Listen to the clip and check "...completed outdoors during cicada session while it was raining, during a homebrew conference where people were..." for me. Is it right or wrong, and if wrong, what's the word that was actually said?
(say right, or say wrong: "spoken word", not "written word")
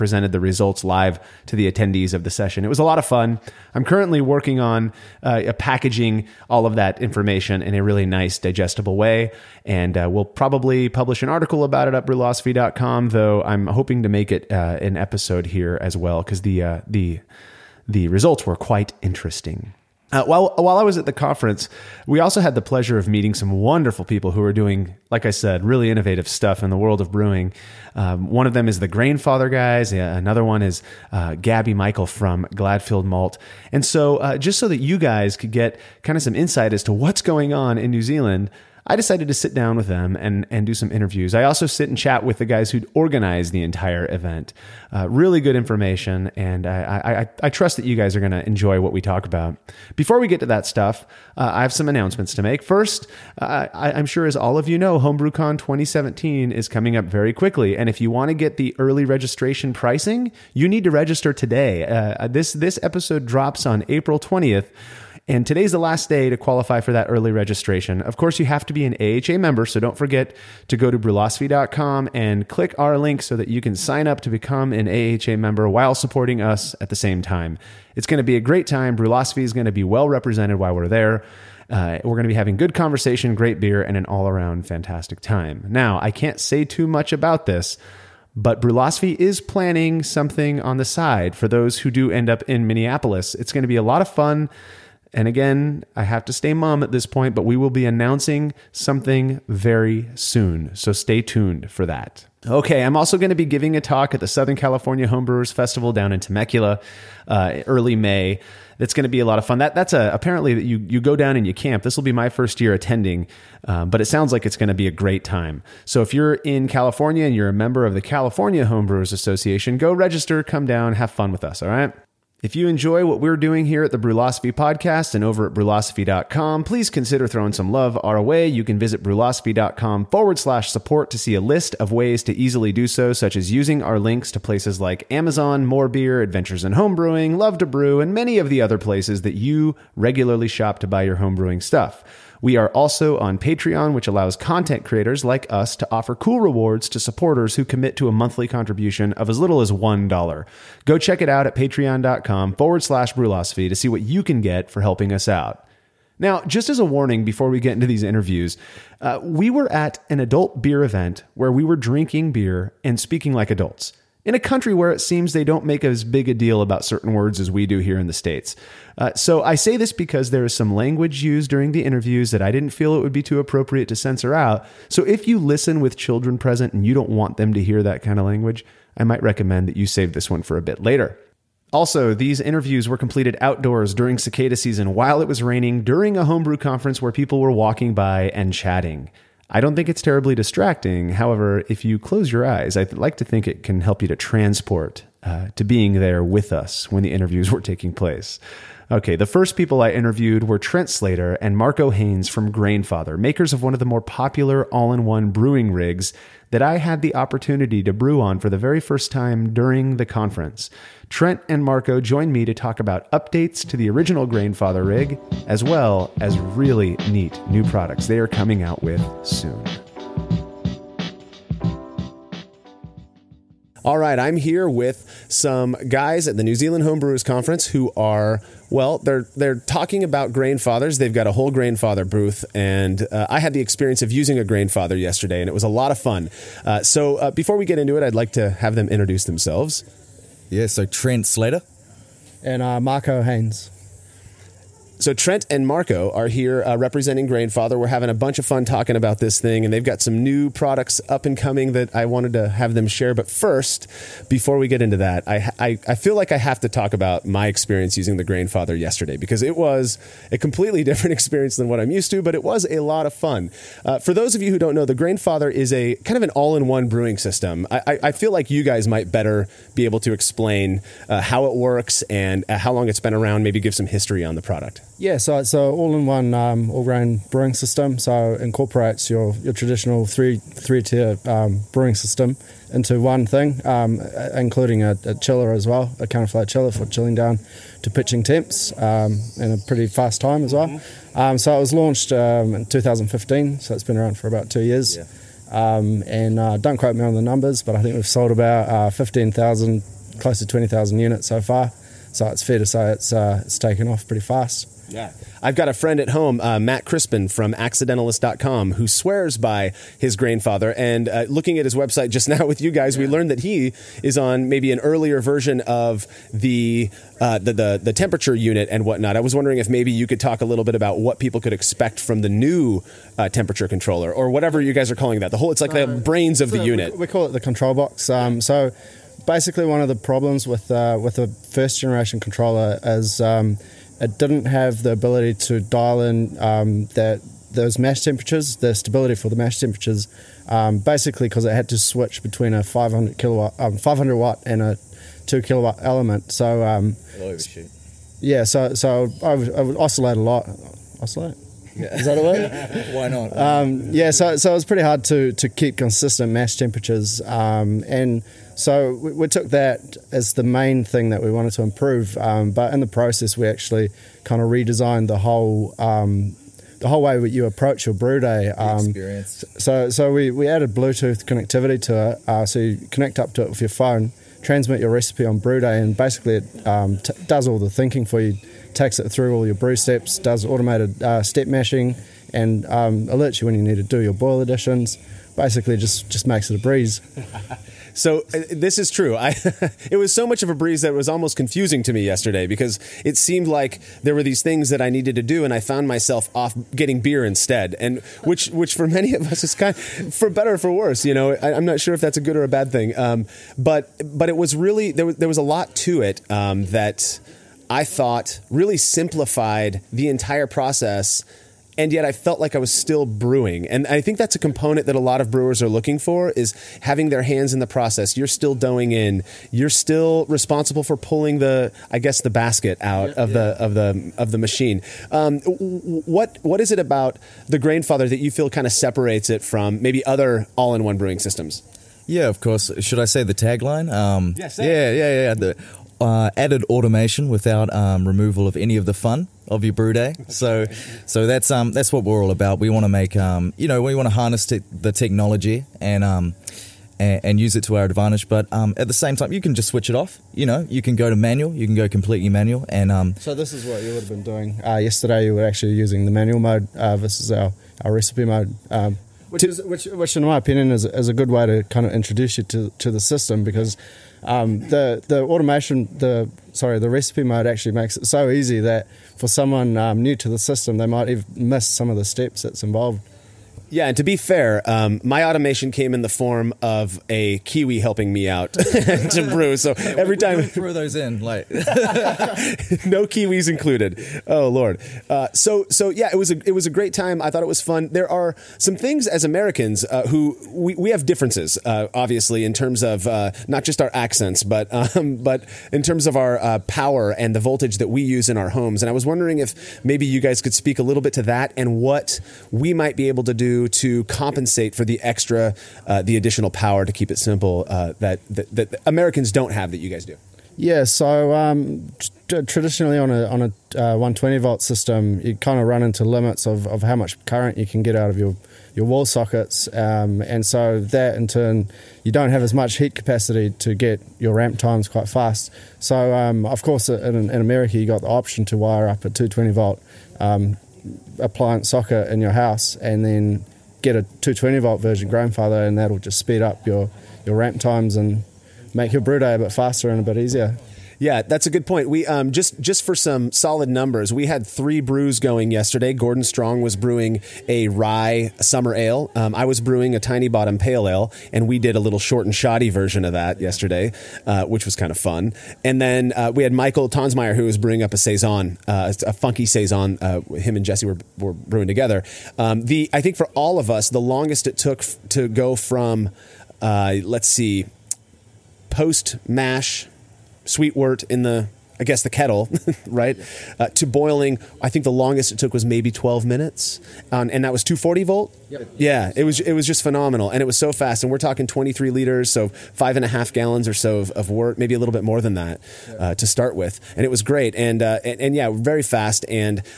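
wrong: "season", not "session".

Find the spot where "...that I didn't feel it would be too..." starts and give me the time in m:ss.
2:52.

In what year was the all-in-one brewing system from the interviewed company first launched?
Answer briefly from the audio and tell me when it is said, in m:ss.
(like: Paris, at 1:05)
2015, at 4:52.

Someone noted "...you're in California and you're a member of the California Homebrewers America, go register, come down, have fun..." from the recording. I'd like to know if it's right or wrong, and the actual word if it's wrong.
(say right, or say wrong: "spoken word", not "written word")
wrong: "Association", not "America".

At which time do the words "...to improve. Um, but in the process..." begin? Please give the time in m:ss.
6:01.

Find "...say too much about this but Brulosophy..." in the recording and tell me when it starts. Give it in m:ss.
1:26.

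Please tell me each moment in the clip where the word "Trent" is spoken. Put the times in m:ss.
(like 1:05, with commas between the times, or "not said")
3:20, 3:31, 4:00, 4:05.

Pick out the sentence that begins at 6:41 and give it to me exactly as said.
You know, I, am not sure if that's a good or a bad thing.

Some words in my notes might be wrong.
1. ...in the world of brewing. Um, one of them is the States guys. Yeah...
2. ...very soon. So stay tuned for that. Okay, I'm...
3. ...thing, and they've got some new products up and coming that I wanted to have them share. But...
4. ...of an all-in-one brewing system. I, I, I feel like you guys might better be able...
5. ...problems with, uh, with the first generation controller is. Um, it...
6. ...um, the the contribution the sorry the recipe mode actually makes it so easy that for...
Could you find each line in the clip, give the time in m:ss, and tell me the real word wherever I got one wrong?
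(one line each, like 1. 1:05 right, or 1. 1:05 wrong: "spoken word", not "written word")
1. 0:26 wrong: "Grainfather", not "States"
2. 1:39 right
3. 4:09 right
4. 4:26 right
5. 5:29 right
6. 7:44 wrong: "automation", not "contribution".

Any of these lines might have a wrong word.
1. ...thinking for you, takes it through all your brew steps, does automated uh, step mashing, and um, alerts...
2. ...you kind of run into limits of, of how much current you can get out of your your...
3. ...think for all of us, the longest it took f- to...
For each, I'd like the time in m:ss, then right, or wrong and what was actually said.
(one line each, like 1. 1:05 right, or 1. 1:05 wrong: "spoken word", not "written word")
1. 6:17 right
2. 8:35 right
3. 9:23 right.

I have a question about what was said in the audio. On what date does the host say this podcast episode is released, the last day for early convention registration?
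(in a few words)
April 20th.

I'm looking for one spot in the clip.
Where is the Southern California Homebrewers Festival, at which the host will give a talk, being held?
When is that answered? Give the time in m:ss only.
1:46.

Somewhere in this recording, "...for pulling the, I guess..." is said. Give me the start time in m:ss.
7:00.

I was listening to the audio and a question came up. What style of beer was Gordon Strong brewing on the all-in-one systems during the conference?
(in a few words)
rye summer ale.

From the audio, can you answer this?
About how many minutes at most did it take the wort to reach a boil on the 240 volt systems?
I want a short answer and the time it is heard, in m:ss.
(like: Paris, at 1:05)
12, at 9:35.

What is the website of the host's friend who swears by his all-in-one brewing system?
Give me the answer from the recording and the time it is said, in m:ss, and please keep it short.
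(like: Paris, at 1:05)
accidentalist.com, at 5:07.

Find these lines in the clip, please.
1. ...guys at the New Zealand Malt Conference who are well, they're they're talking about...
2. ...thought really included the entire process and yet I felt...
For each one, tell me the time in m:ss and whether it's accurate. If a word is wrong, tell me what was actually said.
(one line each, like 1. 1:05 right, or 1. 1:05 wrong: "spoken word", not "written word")
1. 3:45 wrong: "Homebrewers", not "Malt"
2. 6:47 wrong: "simplified", not "included".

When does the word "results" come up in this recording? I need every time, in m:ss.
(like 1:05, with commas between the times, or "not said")
0:00, 0:18.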